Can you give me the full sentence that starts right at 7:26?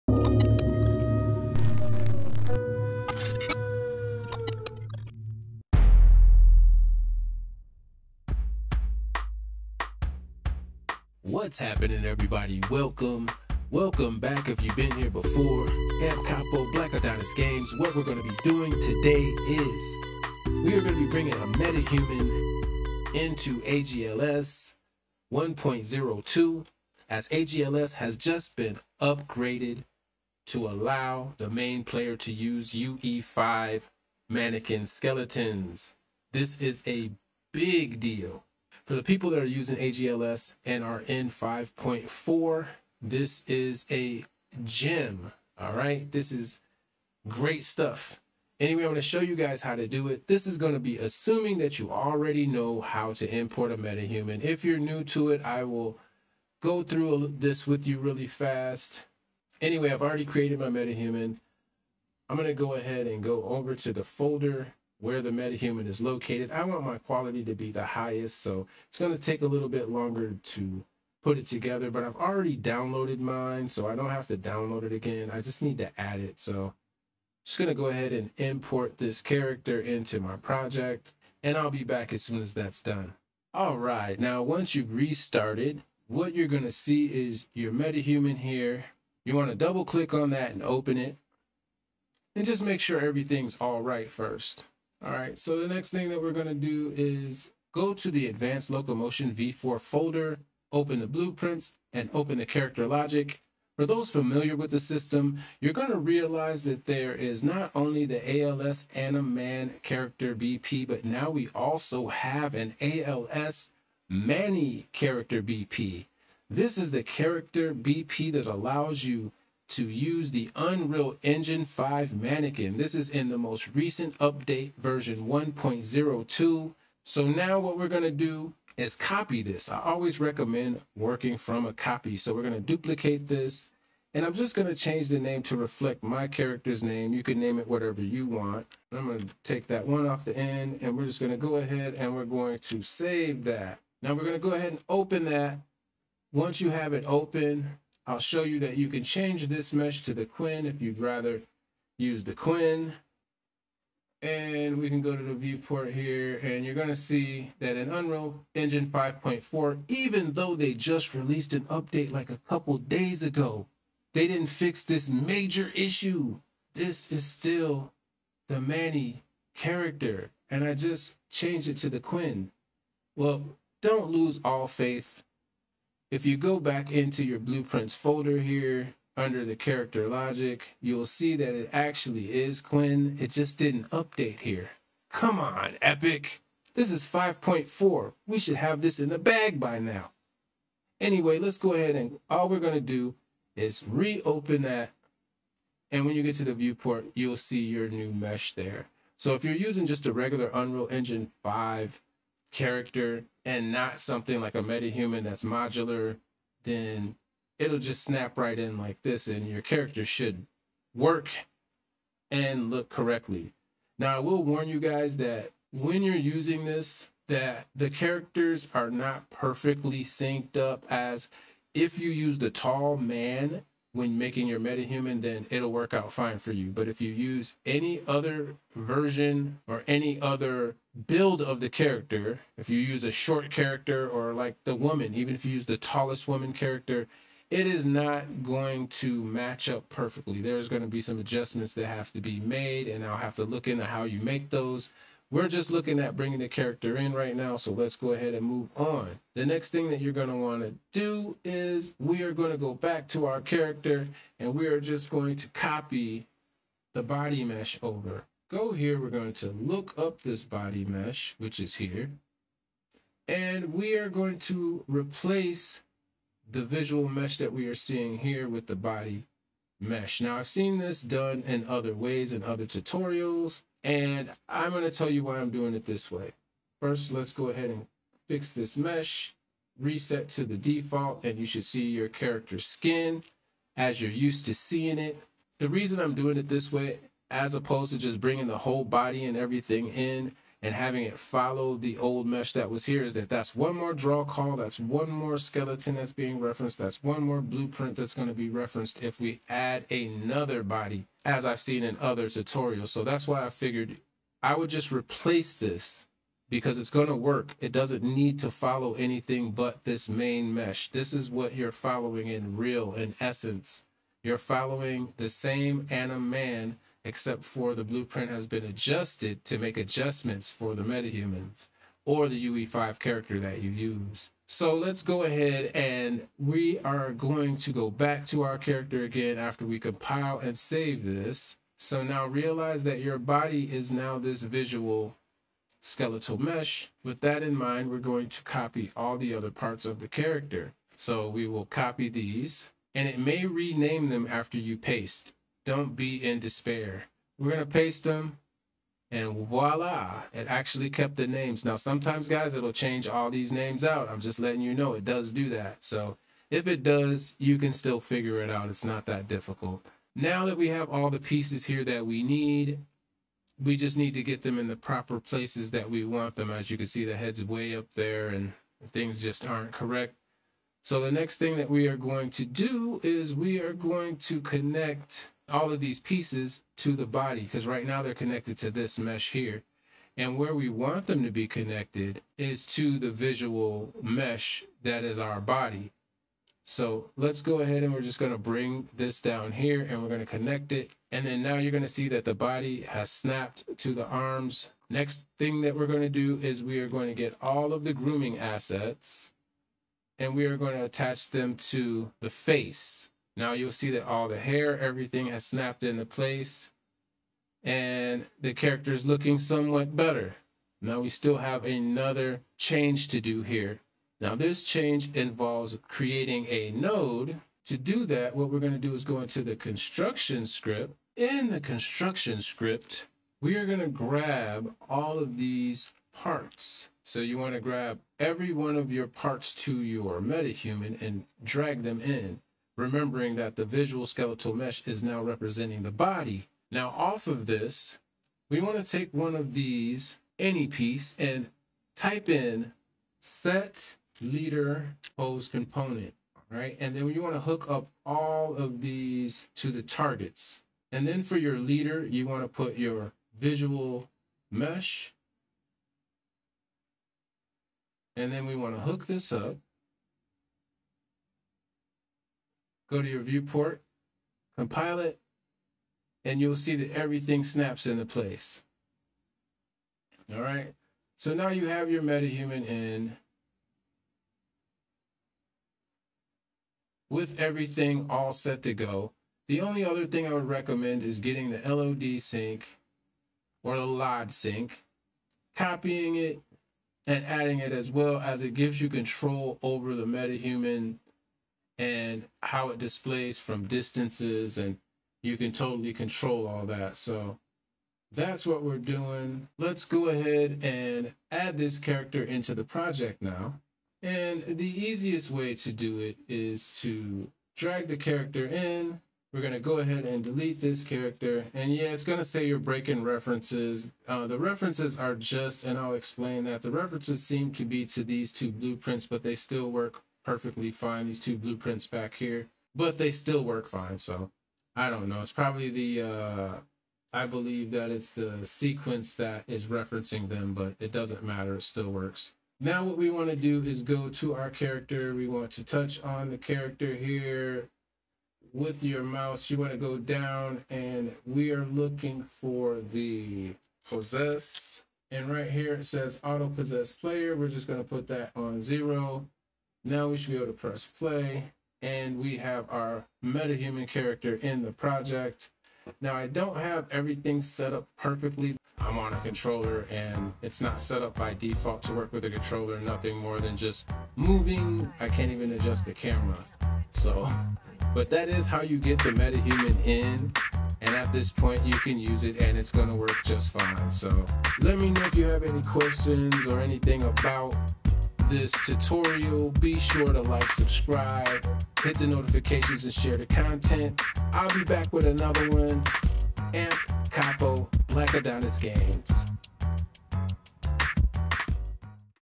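And then you want to hook up all of these to the targets.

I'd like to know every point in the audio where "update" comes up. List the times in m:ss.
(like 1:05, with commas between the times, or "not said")
2:04, 2:41, 3:03.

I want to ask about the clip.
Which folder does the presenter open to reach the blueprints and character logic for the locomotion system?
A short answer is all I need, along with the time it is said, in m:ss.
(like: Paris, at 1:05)
Advanced Locomotion V4, at 1:38.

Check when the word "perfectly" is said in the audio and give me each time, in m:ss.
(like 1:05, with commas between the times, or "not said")
3:39, 3:59, 8:40, 9:17.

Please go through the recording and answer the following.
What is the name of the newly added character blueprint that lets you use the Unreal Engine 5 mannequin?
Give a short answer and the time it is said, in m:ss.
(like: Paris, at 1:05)
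ALS Manny character BP, at 1:52.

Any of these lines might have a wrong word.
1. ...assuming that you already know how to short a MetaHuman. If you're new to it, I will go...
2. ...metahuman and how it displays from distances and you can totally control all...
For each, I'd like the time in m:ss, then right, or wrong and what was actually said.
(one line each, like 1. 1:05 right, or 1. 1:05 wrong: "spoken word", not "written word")
1. 0:50 wrong: "import", not "short"
2. 8:10 right.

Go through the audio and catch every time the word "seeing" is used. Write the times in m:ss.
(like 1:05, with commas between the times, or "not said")
4:27, 4:44.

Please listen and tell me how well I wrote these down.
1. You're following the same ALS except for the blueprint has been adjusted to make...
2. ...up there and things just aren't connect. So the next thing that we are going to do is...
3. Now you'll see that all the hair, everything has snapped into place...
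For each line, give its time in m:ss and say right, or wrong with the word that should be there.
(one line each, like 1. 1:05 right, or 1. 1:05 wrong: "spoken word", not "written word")
1. 5:14 wrong: "AnimMan", not "ALS"
2. 6:07 wrong: "correct", not "connect"
3. 6:43 right.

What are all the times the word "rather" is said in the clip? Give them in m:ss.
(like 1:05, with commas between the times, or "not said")
2:30.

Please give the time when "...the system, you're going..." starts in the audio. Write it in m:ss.
1:44.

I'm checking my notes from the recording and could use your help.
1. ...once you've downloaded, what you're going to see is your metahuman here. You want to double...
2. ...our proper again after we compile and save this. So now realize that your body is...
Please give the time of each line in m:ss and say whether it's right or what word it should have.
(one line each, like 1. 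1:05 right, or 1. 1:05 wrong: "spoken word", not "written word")
1. 1:24 wrong: "restarted", not "downloaded"
2. 5:28 wrong: "character", not "proper".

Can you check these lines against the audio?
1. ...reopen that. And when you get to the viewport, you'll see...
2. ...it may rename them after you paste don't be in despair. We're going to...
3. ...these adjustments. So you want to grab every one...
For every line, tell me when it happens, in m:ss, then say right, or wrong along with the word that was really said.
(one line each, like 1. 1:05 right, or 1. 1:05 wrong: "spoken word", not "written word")
1. 3:13 right
2. 5:43 right
3. 7:05 wrong: "parts", not "adjustments".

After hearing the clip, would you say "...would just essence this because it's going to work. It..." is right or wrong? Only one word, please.
wrong.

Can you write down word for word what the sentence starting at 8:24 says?
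And the easiest way to do it is to drag the character in.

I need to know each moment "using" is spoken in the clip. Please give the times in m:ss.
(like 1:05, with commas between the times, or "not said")
0:39, 3:19, 3:36.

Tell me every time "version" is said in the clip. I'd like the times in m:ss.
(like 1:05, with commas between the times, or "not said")
2:04, 3:48.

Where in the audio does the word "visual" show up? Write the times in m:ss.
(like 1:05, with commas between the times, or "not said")
4:26, 5:34, 6:23, 7:13, 7:33.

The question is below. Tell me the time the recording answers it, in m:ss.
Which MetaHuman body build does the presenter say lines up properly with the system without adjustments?
3:42.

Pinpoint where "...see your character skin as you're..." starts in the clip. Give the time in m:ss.
4:41.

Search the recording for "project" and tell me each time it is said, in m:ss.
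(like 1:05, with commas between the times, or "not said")
1:20, 8:22, 9:14.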